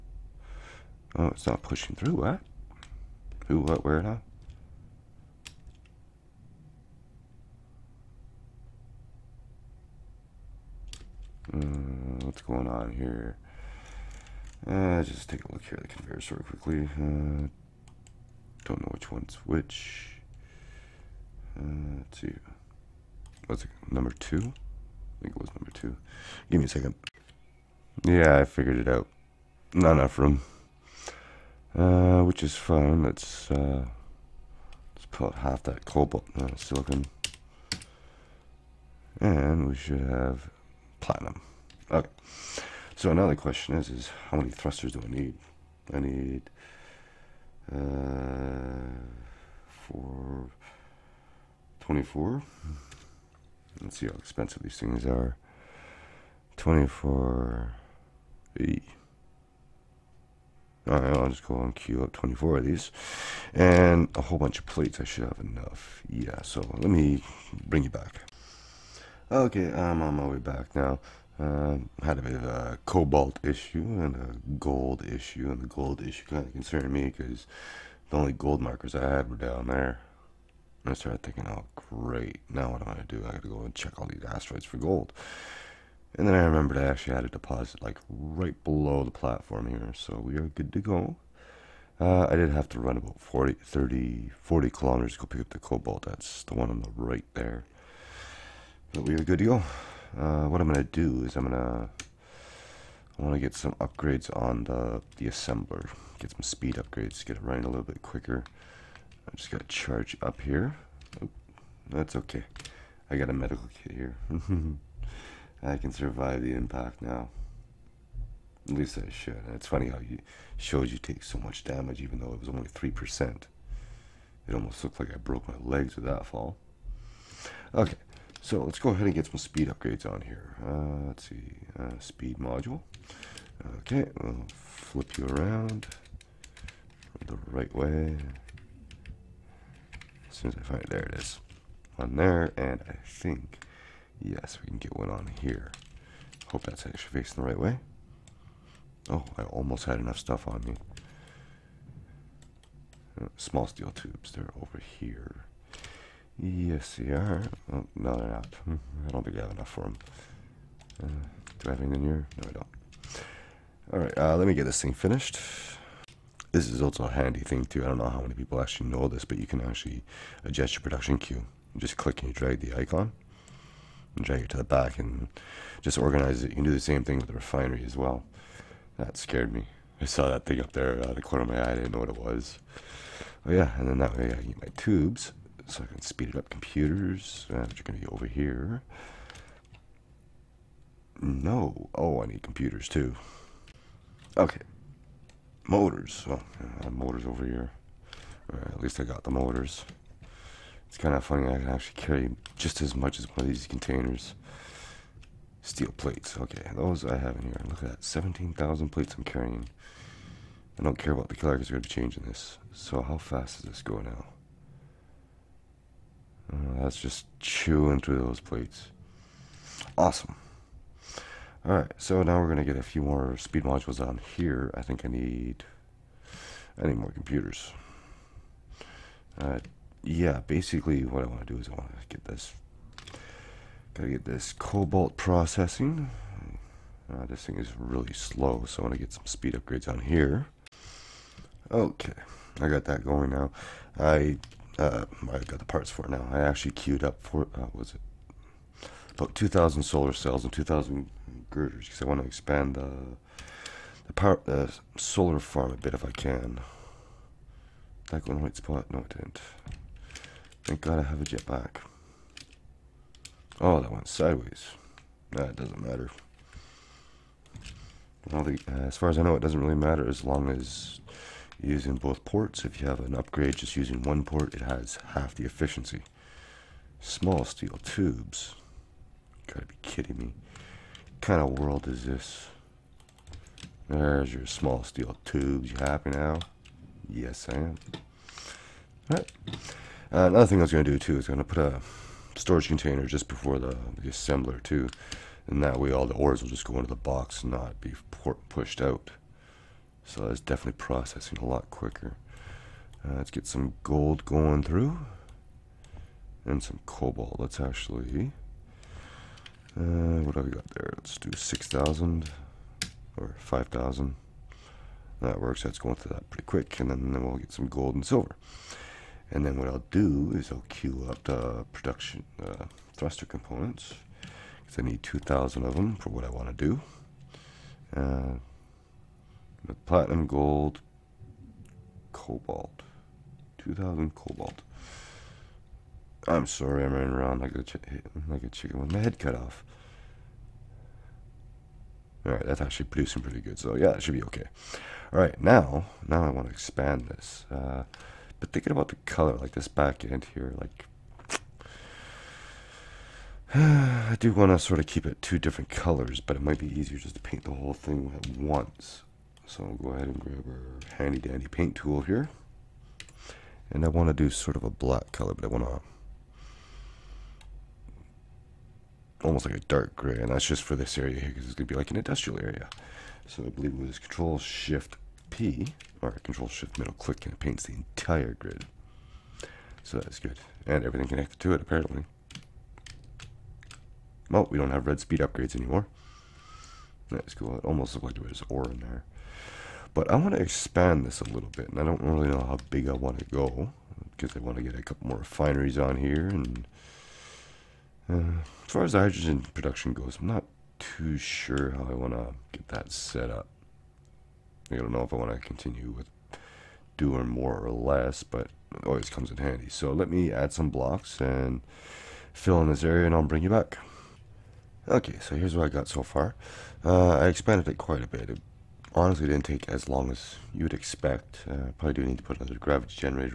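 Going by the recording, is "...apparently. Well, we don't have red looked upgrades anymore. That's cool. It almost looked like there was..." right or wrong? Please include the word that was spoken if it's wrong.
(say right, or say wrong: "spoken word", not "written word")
wrong: "speed", not "looked".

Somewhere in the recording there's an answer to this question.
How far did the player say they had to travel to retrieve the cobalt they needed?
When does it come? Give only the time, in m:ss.
1:33.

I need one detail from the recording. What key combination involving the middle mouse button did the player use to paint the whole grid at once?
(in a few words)
Control Shift Middle Click.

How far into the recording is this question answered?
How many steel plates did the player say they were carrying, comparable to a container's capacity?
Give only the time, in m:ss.
3:28.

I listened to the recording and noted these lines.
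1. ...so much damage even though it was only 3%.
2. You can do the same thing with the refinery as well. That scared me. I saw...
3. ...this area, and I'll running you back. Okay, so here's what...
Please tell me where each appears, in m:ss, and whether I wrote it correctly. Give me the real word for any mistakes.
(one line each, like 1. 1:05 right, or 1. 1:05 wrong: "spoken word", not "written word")
1. 2:01 right
2. 2:56 right
3. 6:52 wrong: "bring", not "running".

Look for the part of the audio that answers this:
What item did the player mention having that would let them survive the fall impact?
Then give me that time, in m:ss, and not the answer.
1:53.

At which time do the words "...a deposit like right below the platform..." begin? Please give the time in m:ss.
1:27.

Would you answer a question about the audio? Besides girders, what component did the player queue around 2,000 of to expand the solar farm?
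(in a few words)
Solar cells.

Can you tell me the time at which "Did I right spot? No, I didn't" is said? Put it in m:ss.
4:18.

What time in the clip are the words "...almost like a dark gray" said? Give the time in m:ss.
6:09.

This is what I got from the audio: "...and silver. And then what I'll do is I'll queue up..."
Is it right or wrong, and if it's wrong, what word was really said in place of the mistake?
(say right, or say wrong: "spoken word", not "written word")
right.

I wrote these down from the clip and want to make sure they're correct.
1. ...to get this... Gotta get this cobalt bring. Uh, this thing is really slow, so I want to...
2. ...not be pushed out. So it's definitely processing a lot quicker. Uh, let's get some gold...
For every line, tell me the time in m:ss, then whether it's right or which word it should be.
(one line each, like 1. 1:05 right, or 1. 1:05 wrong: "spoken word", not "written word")
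1. 3:51 wrong: "processing", not "bring"
2. 4:57 right.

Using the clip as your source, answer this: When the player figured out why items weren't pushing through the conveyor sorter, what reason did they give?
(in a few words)
Not enough room.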